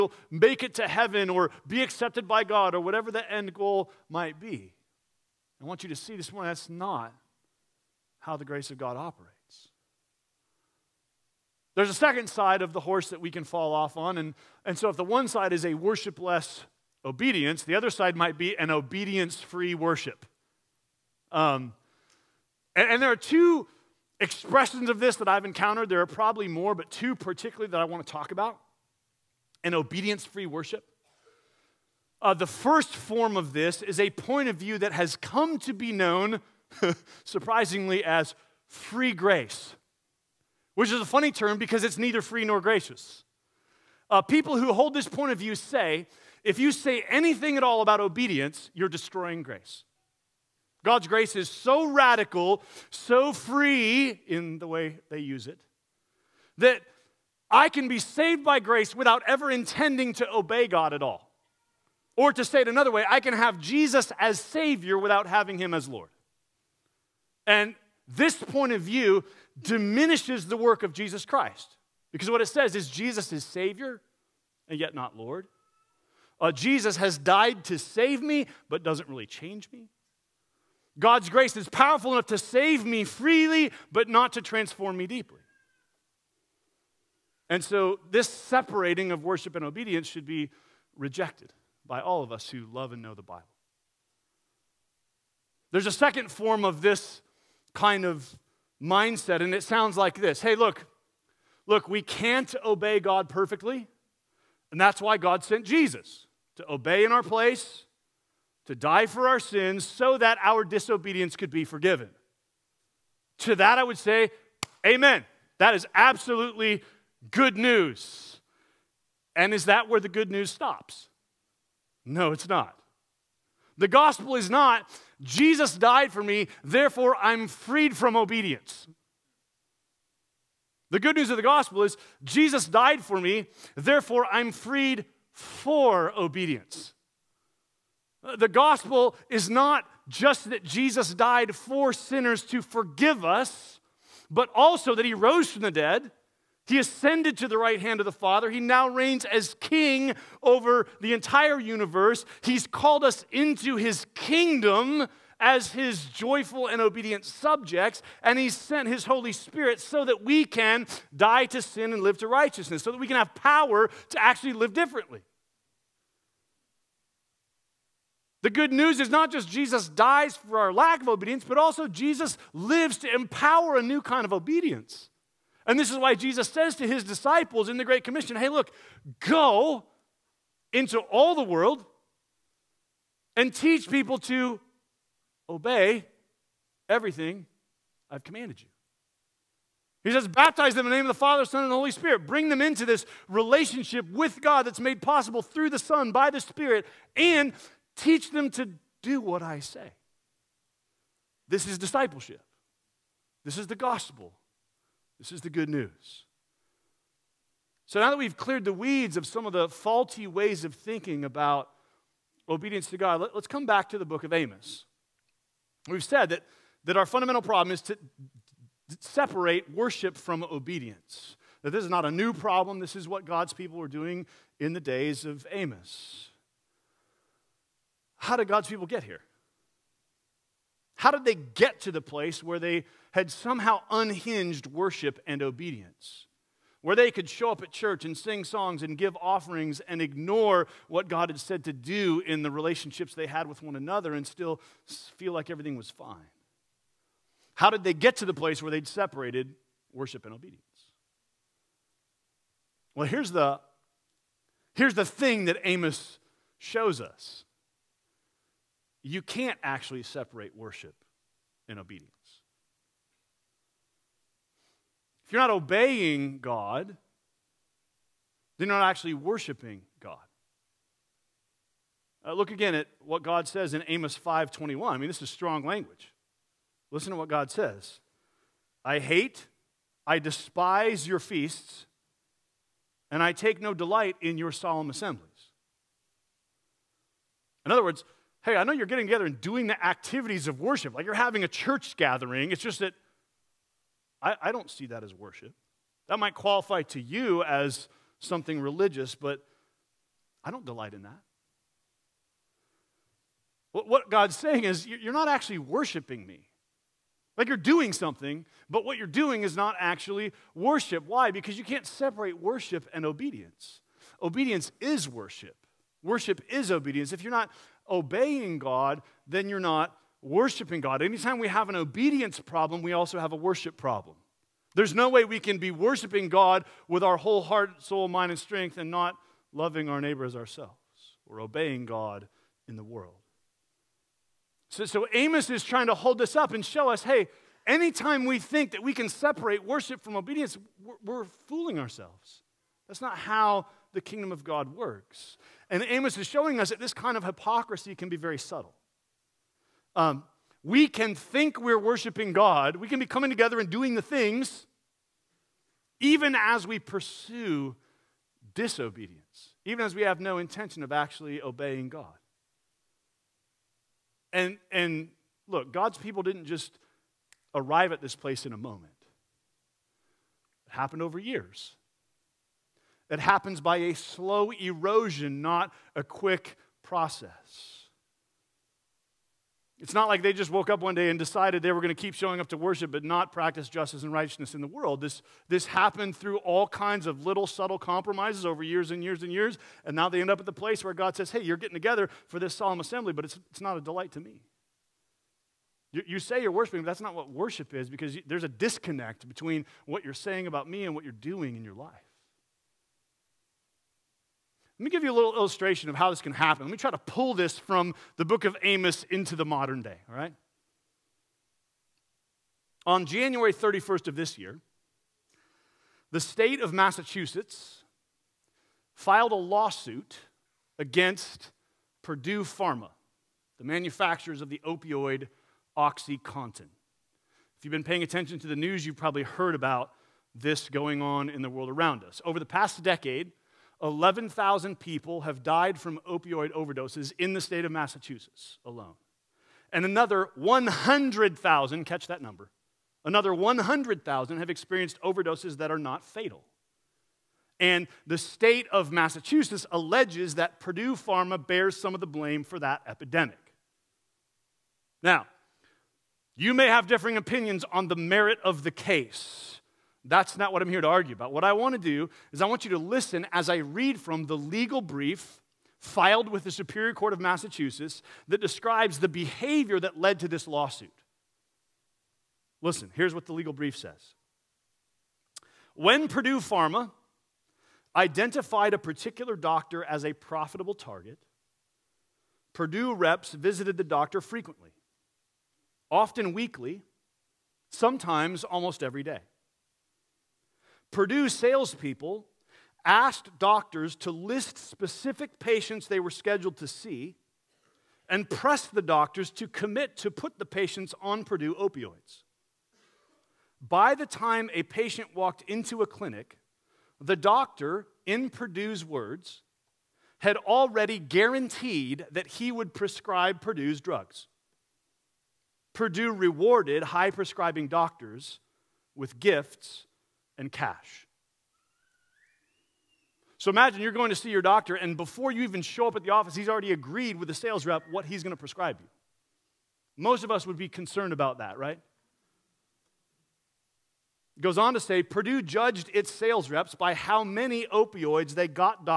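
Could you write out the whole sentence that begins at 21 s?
Um, and, and there are two expressions of this that I've encountered.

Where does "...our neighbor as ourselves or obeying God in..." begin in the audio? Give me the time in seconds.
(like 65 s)
329 s.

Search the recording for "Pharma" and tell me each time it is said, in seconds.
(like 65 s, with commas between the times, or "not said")
422 s, 450 s, 476 s.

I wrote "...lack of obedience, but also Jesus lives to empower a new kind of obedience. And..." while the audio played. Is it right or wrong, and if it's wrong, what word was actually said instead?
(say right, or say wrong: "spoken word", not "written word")
right.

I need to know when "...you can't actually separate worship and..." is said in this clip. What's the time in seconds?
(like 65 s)
259 s.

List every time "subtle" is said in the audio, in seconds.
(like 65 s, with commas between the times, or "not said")
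348 s, 387 s.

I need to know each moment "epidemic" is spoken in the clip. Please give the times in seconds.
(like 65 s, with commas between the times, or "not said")
452 s.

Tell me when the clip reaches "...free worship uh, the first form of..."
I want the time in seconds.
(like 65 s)
30 s.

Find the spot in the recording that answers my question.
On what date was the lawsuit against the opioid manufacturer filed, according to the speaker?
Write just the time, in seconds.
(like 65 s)
413 s.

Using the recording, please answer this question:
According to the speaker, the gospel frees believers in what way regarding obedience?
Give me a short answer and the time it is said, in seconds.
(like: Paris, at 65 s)
for obedience, at 134 s.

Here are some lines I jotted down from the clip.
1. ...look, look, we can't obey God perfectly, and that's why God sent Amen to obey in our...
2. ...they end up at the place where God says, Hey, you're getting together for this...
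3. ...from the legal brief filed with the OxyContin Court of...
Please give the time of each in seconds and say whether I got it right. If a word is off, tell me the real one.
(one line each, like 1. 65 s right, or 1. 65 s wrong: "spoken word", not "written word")
1. 100 s wrong: "Jesus", not "Amen"
2. 390 s right
3. 463 s wrong: "Superior", not "OxyContin".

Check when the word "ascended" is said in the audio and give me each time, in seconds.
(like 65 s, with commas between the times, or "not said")
146 s.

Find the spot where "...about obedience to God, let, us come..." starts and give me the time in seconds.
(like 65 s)
211 s.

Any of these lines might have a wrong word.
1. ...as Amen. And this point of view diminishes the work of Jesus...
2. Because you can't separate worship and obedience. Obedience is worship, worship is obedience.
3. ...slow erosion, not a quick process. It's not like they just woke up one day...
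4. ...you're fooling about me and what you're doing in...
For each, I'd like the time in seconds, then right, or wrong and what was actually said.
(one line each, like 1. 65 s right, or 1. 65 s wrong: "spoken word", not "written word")
1. 65 s wrong: "Lord", not "Amen"
2. 311 s right
3. 373 s right
4. 400 s wrong: "saying", not "fooling".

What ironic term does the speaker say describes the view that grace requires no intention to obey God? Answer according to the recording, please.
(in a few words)
free grace.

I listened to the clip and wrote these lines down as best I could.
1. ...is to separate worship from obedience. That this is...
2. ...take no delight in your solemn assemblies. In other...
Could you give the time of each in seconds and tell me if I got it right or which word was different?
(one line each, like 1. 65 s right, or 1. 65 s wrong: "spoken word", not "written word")
1. 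217 s right
2. 283 s right.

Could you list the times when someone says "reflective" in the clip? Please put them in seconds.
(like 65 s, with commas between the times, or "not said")
not said.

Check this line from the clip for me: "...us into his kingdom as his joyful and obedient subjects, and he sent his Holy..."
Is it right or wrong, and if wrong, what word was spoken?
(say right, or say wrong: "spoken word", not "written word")
right.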